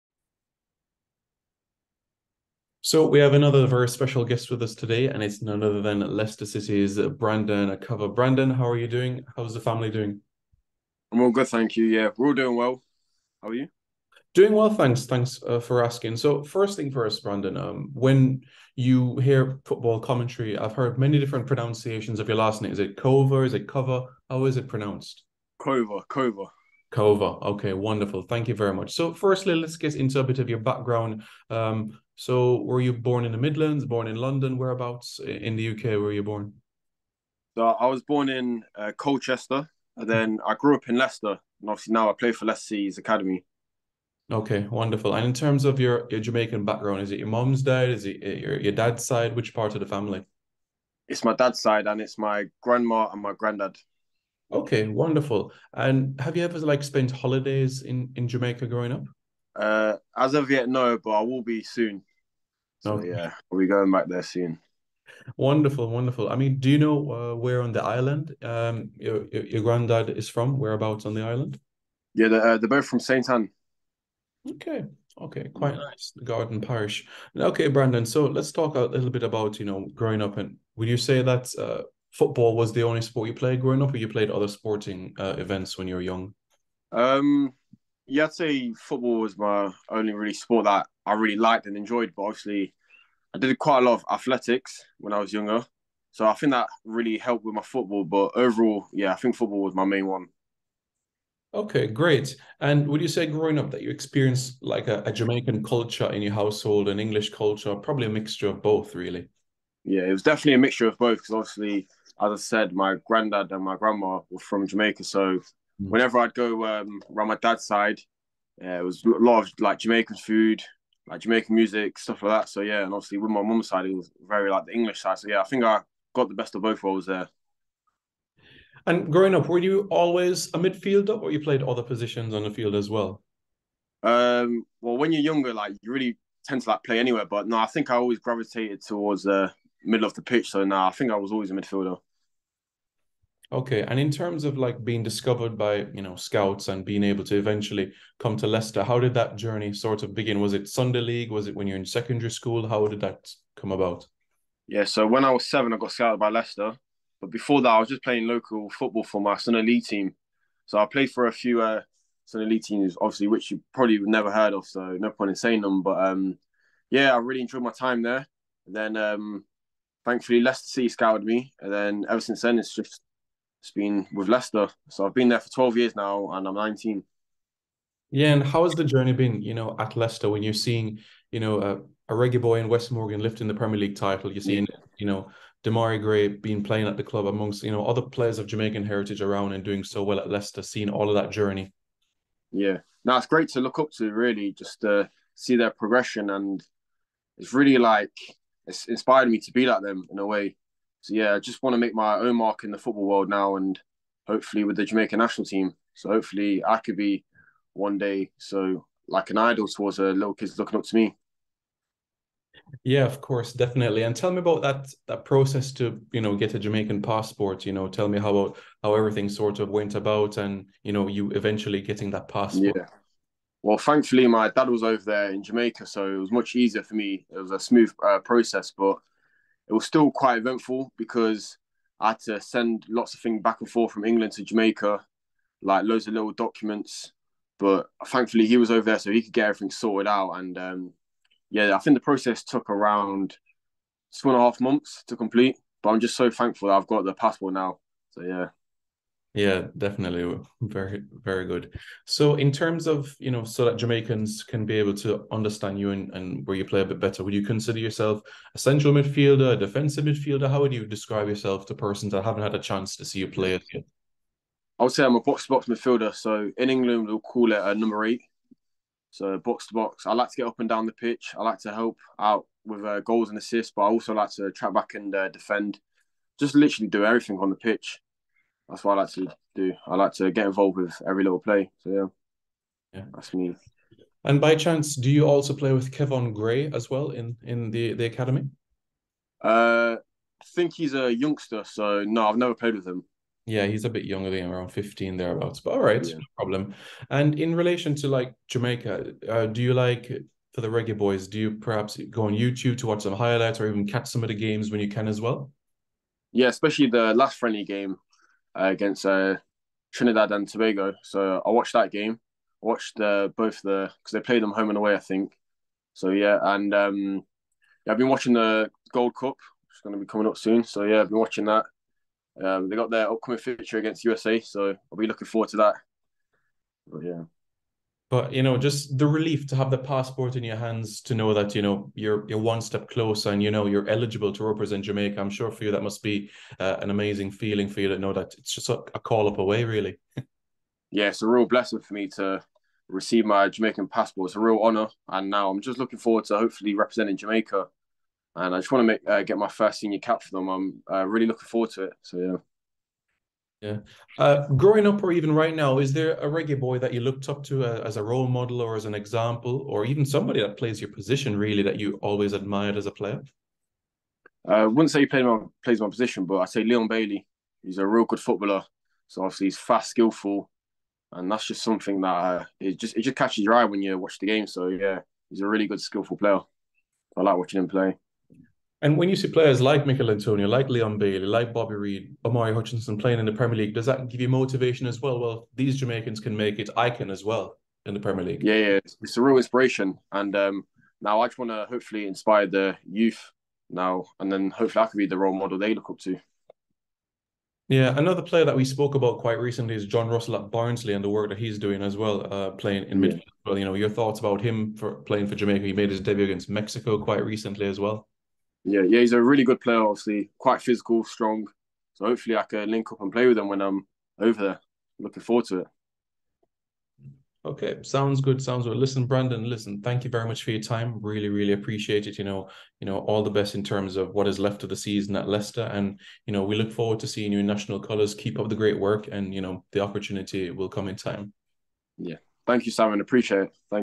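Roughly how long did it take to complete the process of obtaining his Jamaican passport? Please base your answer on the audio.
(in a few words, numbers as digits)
2 and a half months.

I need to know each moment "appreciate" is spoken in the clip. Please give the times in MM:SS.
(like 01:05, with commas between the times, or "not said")
07:01, 07:13.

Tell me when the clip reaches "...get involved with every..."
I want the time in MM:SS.
04:40.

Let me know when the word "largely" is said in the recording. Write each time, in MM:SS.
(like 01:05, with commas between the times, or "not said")
not said.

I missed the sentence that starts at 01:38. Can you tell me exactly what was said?
But overall, yeah, I think football was my main one.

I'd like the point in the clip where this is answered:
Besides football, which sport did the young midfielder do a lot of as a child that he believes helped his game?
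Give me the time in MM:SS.
01:34.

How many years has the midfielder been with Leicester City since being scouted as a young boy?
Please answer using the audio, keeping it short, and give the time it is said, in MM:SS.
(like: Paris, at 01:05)
12, at 02:55.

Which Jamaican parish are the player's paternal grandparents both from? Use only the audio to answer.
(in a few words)
Saint Ann.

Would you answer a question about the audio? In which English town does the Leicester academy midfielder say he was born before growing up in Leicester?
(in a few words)
Colchester.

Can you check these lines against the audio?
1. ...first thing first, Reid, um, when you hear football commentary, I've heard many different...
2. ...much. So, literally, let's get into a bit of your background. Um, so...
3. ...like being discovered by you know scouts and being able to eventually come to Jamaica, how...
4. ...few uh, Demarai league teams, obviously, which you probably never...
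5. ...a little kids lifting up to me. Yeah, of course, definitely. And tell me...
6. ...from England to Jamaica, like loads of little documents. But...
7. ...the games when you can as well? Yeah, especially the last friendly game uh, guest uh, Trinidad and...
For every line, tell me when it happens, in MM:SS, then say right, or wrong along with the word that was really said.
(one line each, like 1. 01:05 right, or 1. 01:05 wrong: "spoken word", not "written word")
1. 00:16 wrong: "Brandon", not "Reid"
2. 00:28 wrong: "firstly", not "literally"
3. 02:24 wrong: "Leicester", not "Jamaica"
4. 02:41 wrong: "Sunday", not "Demarai"
5. 03:29 wrong: "looking", not "lifting"
6. 03:53 right
7. 05:04 wrong: "against", not "guest".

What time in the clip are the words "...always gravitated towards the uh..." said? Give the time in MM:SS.
02:17.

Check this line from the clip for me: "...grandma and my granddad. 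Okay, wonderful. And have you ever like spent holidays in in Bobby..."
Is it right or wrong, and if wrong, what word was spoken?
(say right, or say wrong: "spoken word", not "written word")
wrong: "Jamaica", not "Bobby".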